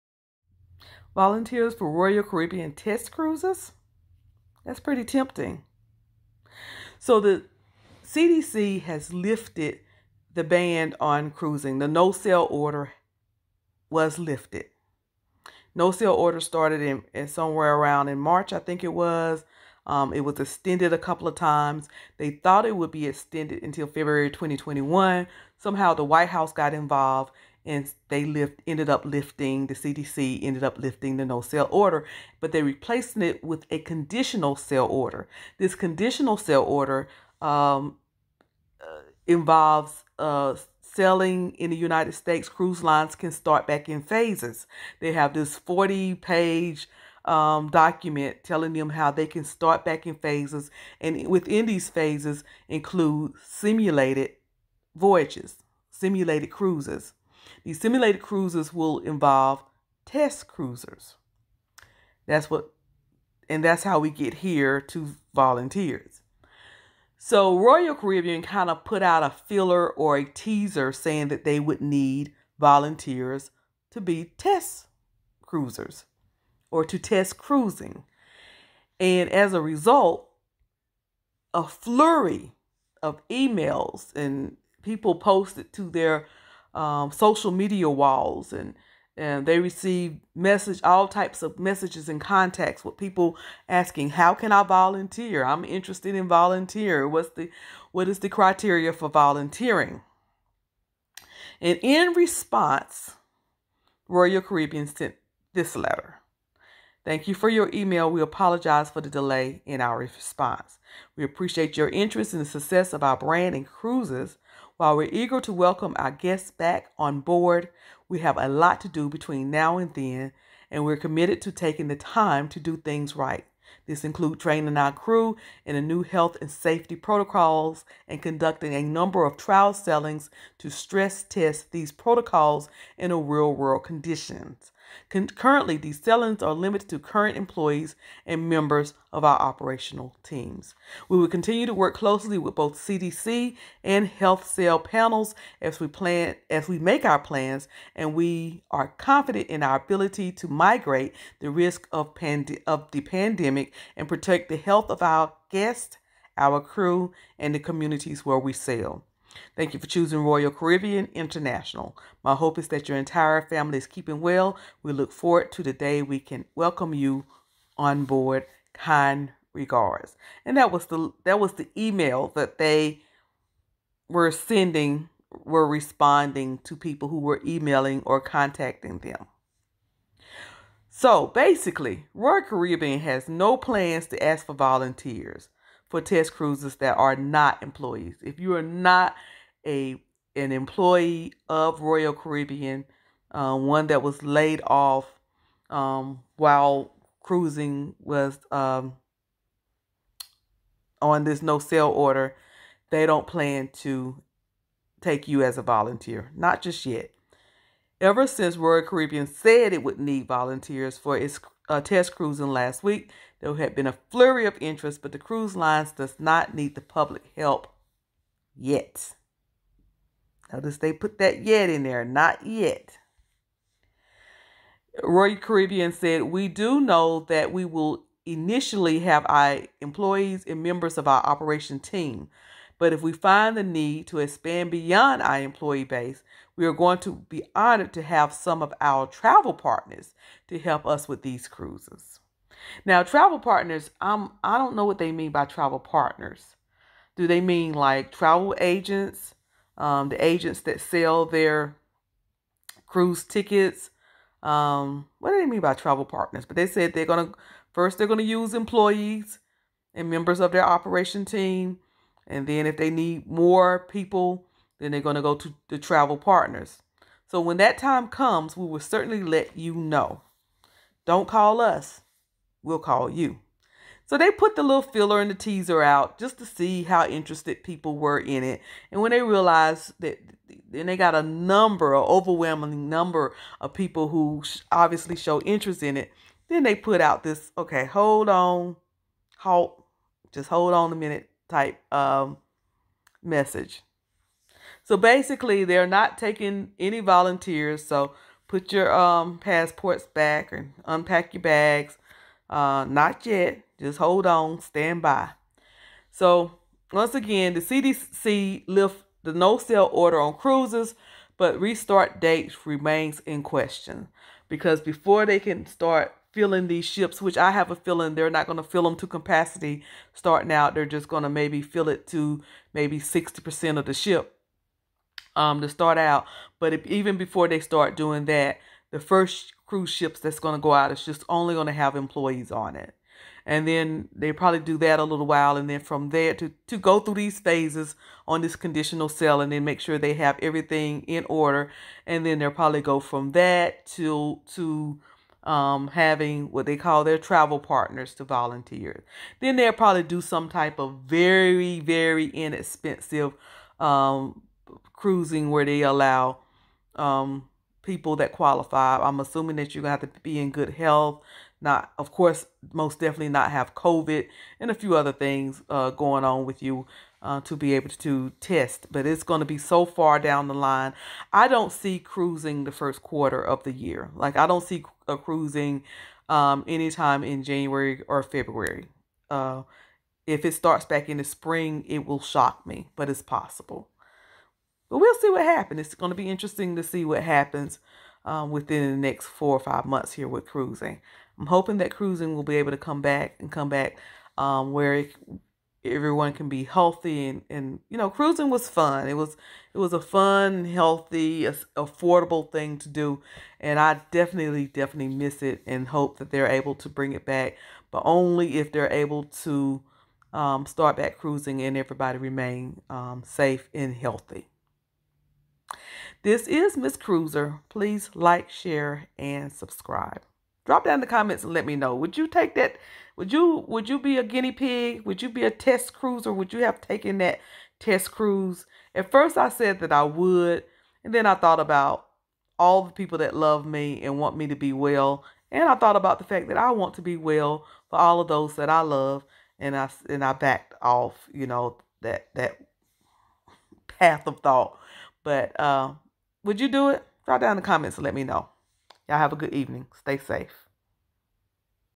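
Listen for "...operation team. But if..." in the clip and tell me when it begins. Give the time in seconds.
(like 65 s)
231 s.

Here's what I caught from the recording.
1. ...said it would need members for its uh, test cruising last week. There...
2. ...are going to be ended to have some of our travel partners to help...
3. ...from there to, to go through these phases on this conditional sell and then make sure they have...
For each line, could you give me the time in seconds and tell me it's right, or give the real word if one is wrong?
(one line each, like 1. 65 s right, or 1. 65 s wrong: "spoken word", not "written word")
1. 209 s wrong: "volunteers", not "members"
2. 236 s wrong: "honored", not "ended"
3. 335 s right.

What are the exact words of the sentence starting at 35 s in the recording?
This conditional sail order um, uh, involves uh, selling in the United States.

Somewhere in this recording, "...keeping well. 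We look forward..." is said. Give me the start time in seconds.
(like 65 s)
163 s.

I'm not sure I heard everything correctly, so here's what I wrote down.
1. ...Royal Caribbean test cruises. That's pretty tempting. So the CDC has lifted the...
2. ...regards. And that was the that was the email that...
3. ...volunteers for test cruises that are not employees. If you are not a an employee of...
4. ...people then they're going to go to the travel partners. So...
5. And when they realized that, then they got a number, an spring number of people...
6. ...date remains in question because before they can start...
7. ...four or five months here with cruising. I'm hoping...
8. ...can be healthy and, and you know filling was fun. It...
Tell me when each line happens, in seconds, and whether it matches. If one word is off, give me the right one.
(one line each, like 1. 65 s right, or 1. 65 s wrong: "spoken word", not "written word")
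1. 1 s right
2. 169 s right
3. 184 s right
4. 263 s right
5. 278 s wrong: "overwhelming", not "spring"
6. 312 s right
7. 389 s right
8. 396 s wrong: "cruising", not "filling".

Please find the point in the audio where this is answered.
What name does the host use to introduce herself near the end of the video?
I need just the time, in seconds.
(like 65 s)
416 s.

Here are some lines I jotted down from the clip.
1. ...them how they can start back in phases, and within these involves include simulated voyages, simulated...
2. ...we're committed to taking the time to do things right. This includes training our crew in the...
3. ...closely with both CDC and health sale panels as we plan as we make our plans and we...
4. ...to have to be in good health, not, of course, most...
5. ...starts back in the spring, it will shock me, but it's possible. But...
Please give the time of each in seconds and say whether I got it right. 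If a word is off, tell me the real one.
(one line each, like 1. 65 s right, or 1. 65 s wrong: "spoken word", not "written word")
1. 48 s wrong: "phases", not "involves"
2. 120 s right
3. 141 s right
4. 359 s right
5. 380 s right.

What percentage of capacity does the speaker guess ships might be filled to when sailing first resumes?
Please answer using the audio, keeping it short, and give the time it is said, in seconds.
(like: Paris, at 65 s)
60%, at 322 s.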